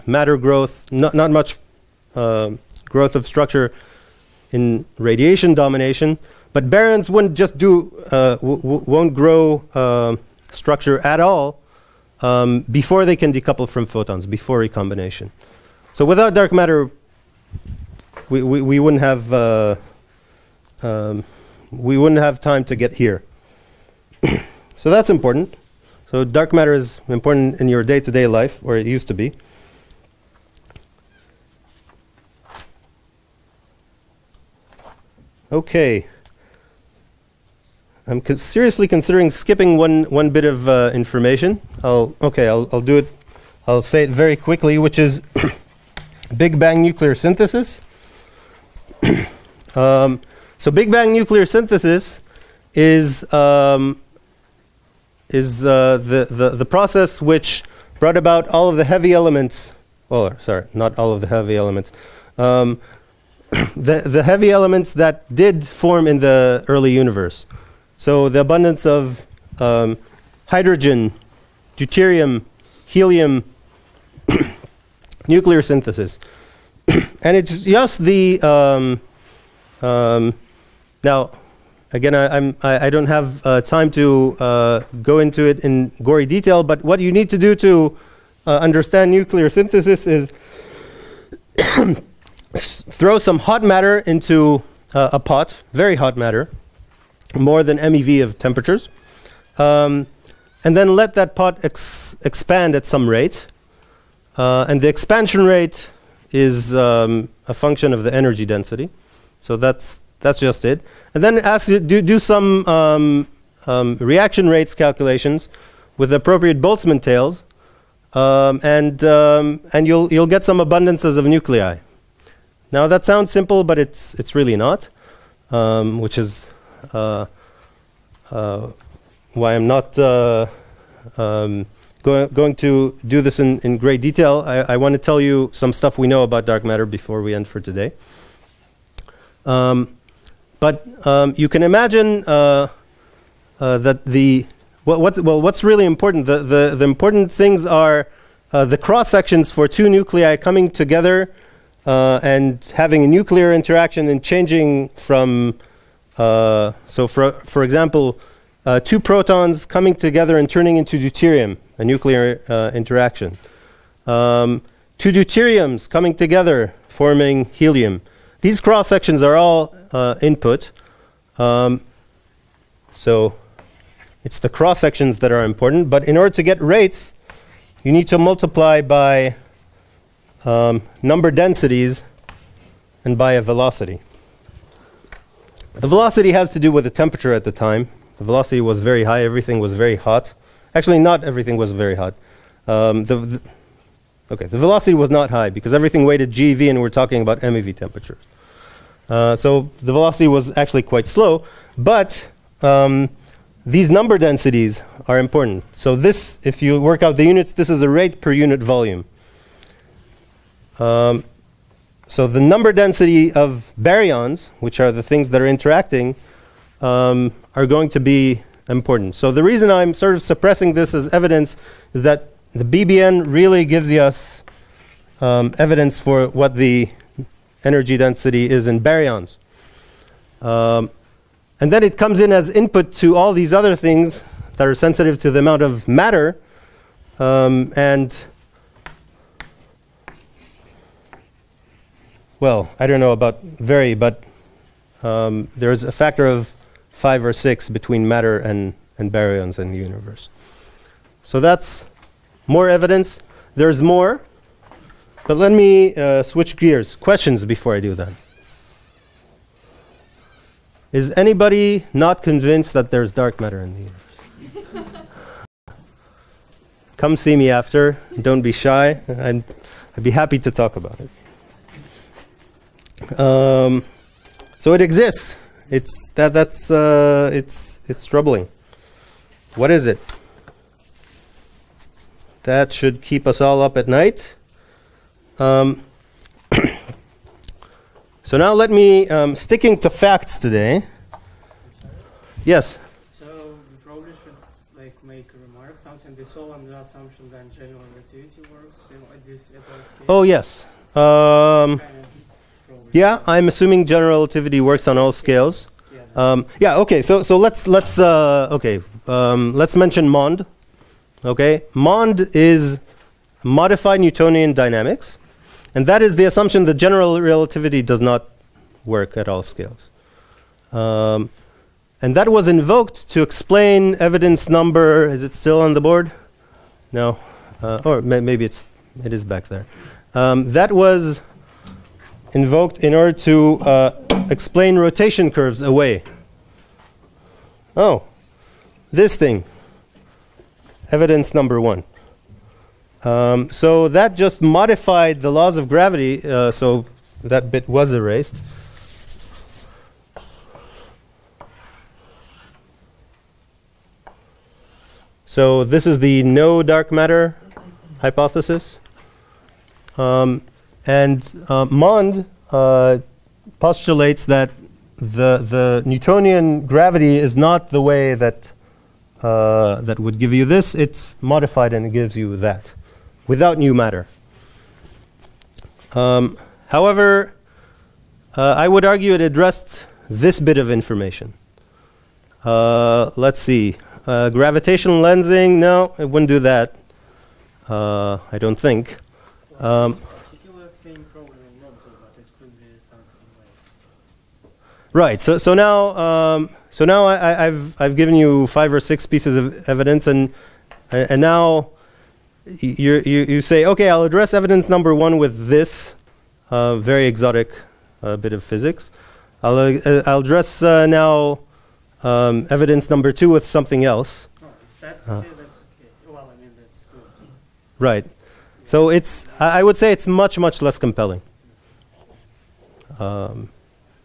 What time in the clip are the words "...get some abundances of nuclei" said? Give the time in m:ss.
2:00.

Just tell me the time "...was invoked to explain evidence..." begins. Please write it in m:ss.
5:22.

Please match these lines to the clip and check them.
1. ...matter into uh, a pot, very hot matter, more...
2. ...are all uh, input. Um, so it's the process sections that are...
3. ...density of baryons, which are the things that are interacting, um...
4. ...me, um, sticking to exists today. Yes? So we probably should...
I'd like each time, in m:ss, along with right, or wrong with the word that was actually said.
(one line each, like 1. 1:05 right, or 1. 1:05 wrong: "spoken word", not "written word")
1. 1:33 right
2. 2:49 wrong: "cross", not "process"
3. 3:32 right
4. 4:48 wrong: "facts", not "exists".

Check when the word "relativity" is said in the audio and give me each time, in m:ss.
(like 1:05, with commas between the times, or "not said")
4:57, 5:04, 5:17.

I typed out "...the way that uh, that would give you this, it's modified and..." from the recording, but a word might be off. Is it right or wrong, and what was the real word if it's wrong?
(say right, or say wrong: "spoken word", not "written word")
right.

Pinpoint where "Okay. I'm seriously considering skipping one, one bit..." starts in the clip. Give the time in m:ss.
0:35.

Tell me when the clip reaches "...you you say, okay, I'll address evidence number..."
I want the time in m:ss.
6:43.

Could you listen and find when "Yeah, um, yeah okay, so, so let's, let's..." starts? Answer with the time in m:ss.
5:05.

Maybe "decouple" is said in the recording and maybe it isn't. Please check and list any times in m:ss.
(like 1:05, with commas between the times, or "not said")
0:13.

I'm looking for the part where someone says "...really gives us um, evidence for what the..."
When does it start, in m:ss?
3:43.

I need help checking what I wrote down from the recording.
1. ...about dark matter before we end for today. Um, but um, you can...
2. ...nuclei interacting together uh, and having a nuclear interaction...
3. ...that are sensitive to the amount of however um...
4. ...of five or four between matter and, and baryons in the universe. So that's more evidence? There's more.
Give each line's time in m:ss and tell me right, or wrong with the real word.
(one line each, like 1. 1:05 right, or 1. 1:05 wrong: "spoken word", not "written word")
1. 2:16 right
2. 2:29 wrong: "coming", not "interacting"
3. 3:54 wrong: "matter", not "however"
4. 4:06 wrong: "six", not "four".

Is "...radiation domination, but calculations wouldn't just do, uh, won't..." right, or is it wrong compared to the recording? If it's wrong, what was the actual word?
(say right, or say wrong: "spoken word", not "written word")
wrong: "baryons", not "calculations".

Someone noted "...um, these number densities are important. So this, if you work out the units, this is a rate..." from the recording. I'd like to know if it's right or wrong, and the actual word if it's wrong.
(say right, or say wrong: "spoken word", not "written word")
right.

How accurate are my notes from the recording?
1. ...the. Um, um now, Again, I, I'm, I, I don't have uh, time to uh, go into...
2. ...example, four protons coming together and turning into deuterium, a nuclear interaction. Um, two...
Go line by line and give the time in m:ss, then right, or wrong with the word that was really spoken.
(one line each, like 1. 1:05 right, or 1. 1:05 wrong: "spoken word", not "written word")
1. 1:17 right
2. 2:37 wrong: "two", not "four".